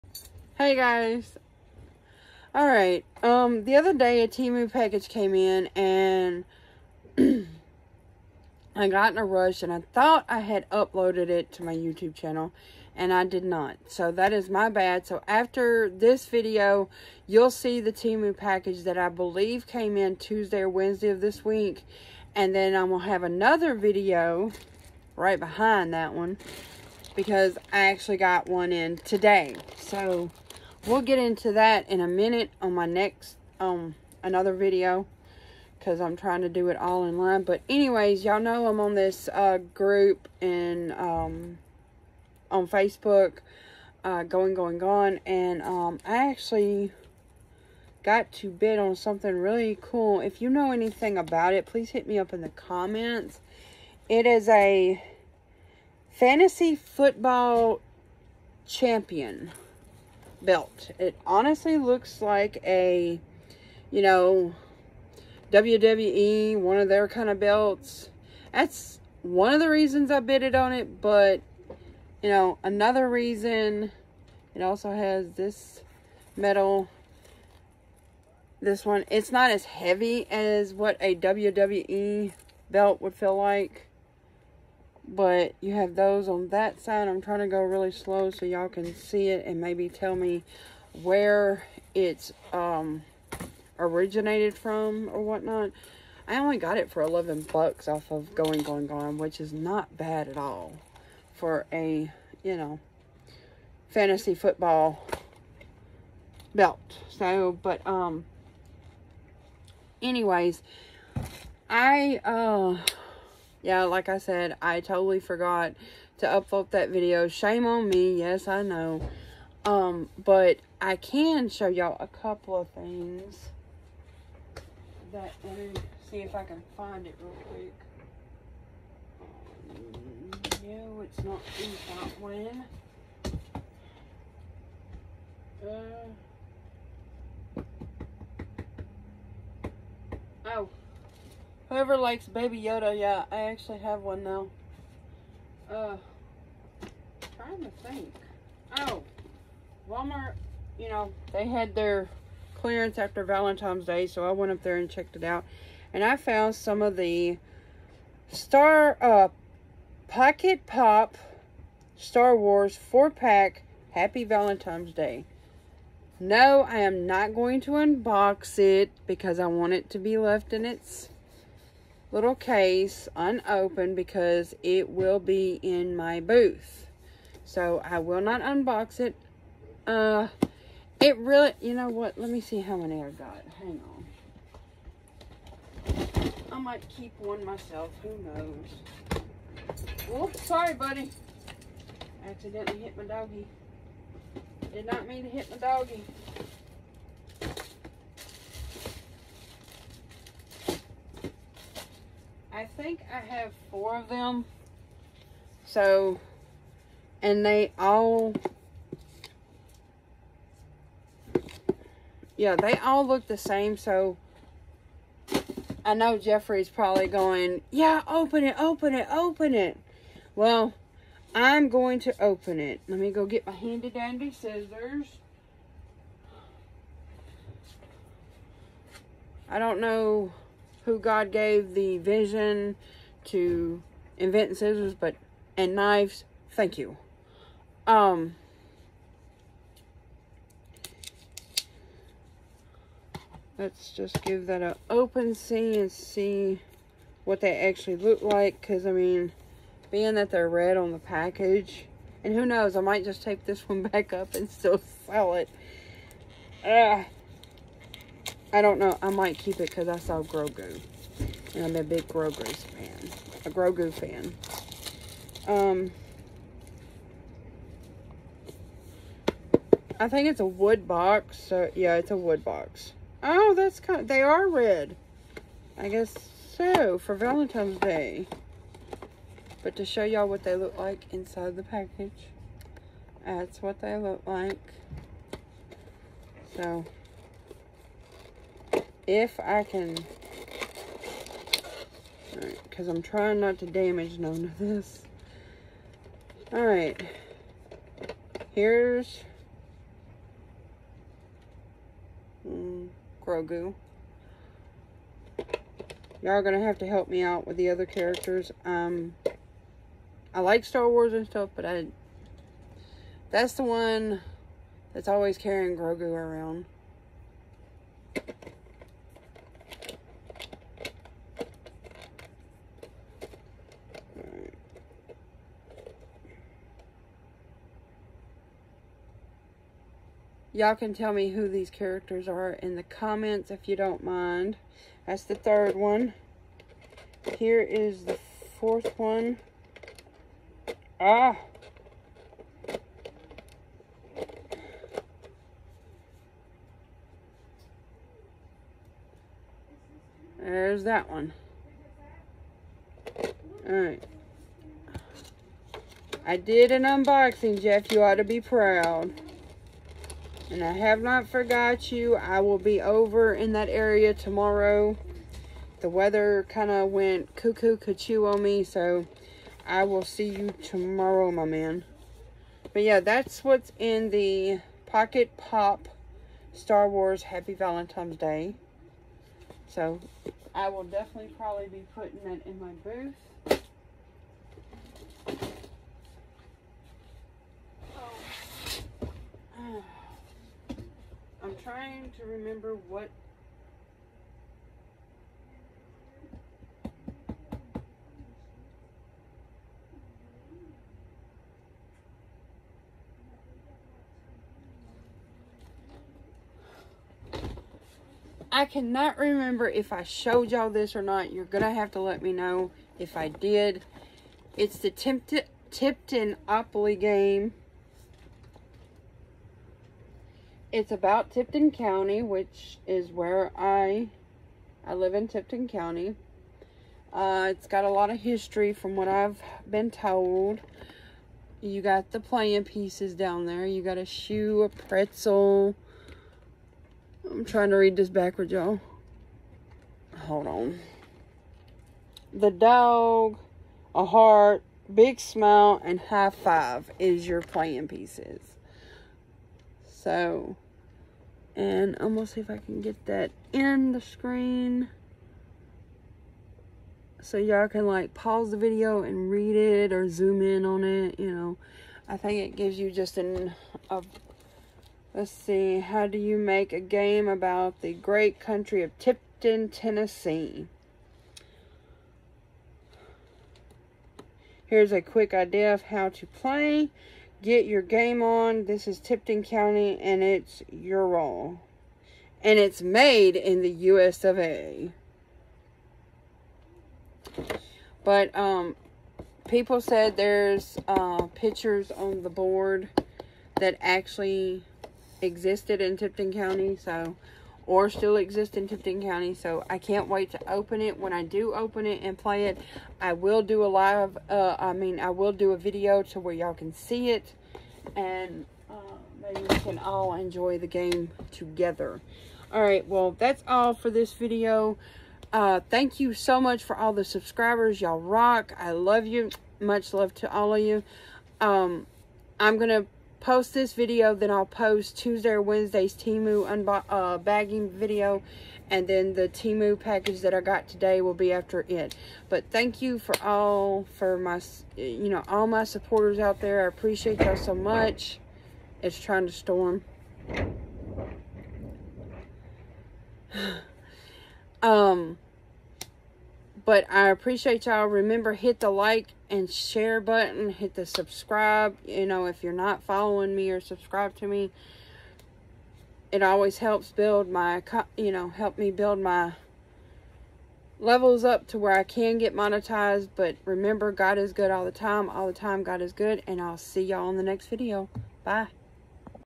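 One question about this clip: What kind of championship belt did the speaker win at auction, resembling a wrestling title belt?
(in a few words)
Fantasy football champion belt.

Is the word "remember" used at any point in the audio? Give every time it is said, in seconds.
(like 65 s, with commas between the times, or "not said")
392 s, 409 s, 547 s, 563 s.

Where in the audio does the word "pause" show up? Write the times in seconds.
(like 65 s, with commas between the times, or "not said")
458 s.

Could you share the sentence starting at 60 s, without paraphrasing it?
It honestly looks like a, you know, WWE, one of their kind of belts.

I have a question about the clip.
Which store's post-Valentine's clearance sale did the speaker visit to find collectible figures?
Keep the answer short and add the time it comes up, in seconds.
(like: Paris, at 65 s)
Walmart, at 149 s.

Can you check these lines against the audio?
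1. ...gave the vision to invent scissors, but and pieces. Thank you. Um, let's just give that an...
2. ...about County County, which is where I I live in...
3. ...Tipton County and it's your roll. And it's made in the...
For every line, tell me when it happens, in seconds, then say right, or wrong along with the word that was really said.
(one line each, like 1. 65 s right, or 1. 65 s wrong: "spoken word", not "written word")
1. 231 s wrong: "knives", not "pieces"
2. 420 s wrong: "Tipton", not "County"
3. 478 s right.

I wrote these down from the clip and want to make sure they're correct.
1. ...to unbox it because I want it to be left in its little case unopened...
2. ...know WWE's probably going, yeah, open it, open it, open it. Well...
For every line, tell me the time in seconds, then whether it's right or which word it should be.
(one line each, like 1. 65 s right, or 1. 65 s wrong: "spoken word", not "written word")
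1. 167 s right
2. 215 s wrong: "Jeffrey", not "WWE".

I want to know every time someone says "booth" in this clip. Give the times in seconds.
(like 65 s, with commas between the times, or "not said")
176 s, 382 s.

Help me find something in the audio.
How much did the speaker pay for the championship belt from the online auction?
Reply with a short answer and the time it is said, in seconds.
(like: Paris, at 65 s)
$11, at 97 s.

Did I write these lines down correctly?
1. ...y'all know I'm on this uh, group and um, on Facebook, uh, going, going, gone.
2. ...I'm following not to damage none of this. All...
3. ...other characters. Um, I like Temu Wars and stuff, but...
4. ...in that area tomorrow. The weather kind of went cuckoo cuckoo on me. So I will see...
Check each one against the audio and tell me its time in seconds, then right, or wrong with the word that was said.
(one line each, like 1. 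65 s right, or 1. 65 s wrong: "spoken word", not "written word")
1. 38 s right
2. 292 s wrong: "trying", not "following"
3. 307 s wrong: "Star", not "Temu"
4. 363 s right.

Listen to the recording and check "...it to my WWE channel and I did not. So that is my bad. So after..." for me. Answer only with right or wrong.
wrong.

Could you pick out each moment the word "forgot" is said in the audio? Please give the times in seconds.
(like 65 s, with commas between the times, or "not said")
115 s, 361 s.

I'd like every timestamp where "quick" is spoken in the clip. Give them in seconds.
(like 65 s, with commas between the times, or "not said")
127 s, 475 s.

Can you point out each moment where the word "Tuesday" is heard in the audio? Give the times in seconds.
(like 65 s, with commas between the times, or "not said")
20 s, 524 s.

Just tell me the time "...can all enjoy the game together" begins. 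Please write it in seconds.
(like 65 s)
509 s.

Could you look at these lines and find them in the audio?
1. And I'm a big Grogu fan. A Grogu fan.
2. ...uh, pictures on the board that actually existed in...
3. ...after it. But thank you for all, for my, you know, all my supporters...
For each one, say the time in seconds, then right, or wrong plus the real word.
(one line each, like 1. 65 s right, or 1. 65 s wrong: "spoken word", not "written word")
1. 261 s right
2. 490 s right
3. 531 s right.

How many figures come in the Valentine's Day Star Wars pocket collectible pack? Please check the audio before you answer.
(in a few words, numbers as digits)
4.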